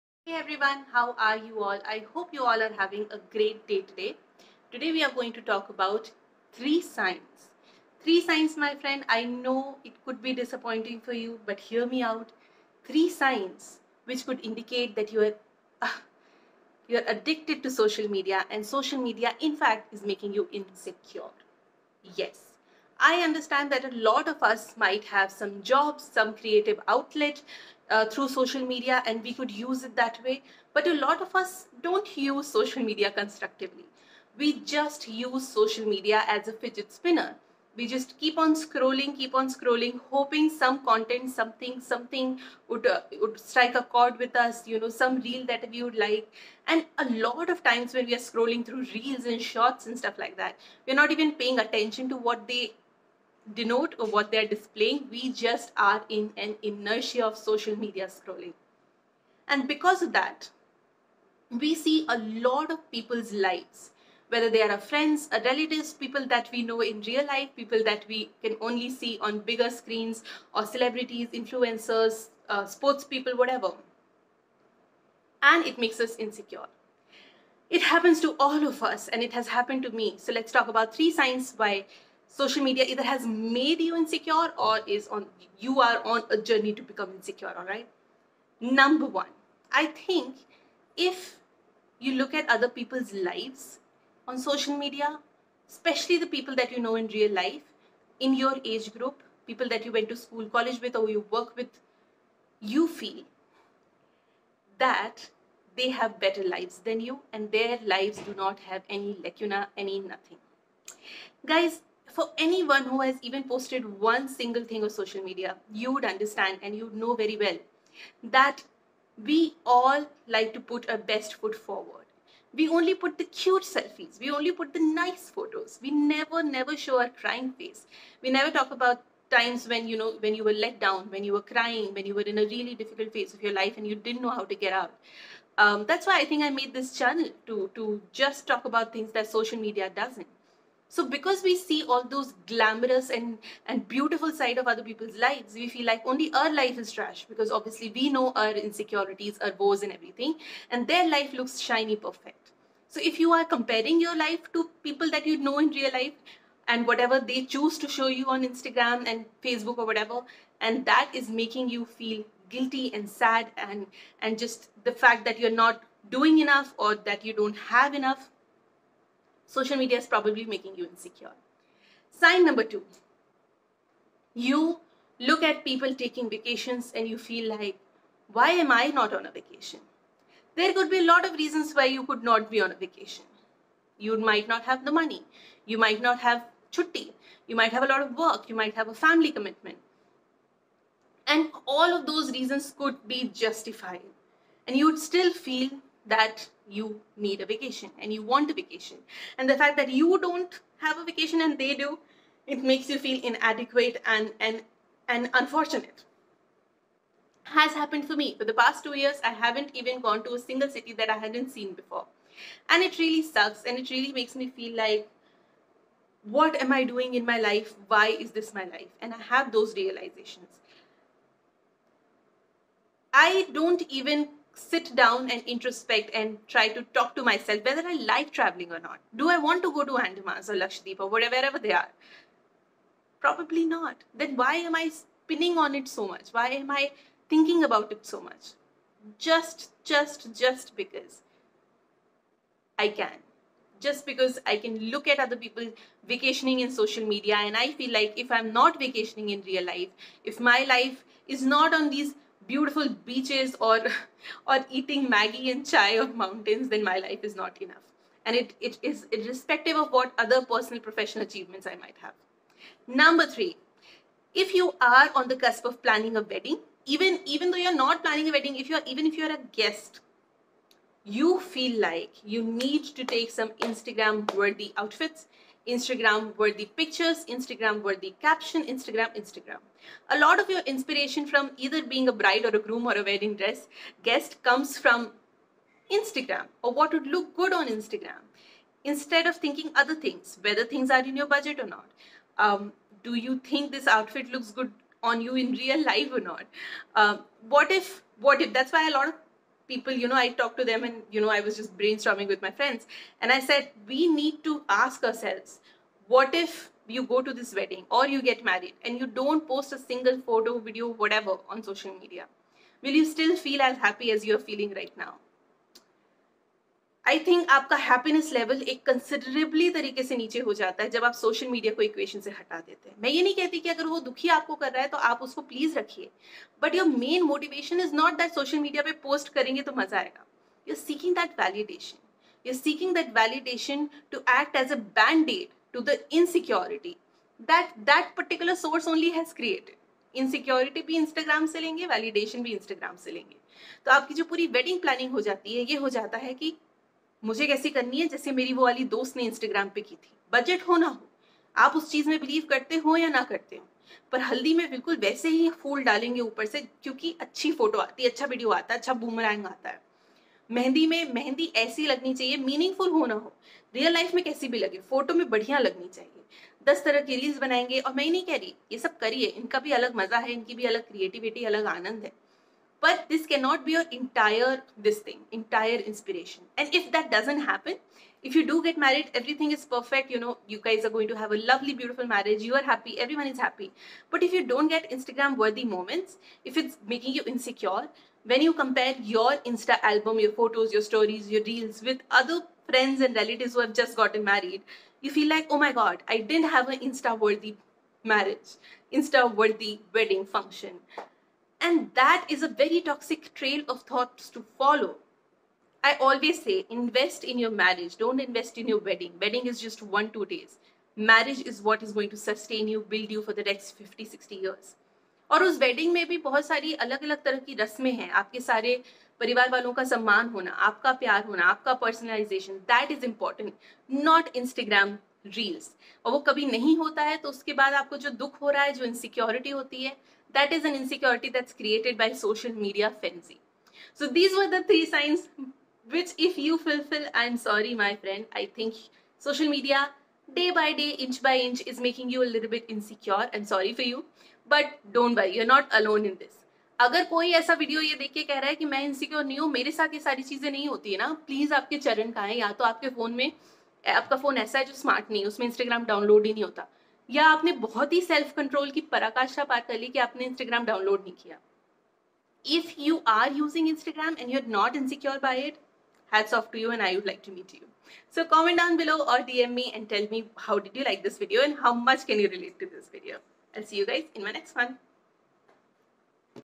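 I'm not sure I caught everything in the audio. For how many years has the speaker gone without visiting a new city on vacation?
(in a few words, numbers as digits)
2.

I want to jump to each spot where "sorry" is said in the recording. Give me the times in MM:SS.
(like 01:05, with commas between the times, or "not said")
07:17, 07:23.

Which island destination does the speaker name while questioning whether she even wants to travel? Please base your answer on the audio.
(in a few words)
Andamans or Lakshadweep.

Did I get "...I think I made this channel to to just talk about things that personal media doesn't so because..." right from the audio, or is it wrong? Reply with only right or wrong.
wrong.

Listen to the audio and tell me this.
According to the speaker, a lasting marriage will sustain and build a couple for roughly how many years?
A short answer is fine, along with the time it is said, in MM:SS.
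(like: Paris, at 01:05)
50 to 60 years, at 06:53.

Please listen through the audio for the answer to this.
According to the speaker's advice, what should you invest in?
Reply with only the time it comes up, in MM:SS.
06:46.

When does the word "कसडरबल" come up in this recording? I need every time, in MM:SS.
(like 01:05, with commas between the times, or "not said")
05:18.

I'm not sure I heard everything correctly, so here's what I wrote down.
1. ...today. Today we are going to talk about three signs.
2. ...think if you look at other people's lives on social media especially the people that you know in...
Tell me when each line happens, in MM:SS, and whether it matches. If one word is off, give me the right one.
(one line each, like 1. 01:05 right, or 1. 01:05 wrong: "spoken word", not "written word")
1. 00:03 right
2. 01:29 right.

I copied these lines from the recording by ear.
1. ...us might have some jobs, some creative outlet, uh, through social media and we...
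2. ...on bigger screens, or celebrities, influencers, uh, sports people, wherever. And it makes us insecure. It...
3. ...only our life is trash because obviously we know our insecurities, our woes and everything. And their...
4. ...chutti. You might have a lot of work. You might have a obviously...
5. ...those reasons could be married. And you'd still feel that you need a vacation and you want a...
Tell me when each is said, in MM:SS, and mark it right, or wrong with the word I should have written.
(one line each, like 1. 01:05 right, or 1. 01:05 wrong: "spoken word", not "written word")
1. 00:24 right
2. 01:09 wrong: "whatever", not "wherever"
3. 02:26 right
4. 03:06 wrong: "family", not "obviously"
5. 03:12 wrong: "justified", not "married".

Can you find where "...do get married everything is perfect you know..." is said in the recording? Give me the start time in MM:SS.
06:18.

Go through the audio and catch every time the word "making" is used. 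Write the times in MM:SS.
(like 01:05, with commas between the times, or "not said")
00:20, 02:41, 02:50, 06:26, 07:21.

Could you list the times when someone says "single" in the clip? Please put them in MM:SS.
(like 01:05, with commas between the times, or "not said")
01:54, 03:30, 05:09.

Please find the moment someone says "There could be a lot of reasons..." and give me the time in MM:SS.
03:00.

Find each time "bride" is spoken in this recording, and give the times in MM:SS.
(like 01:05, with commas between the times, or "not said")
04:42.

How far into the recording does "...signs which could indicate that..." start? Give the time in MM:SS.
00:13.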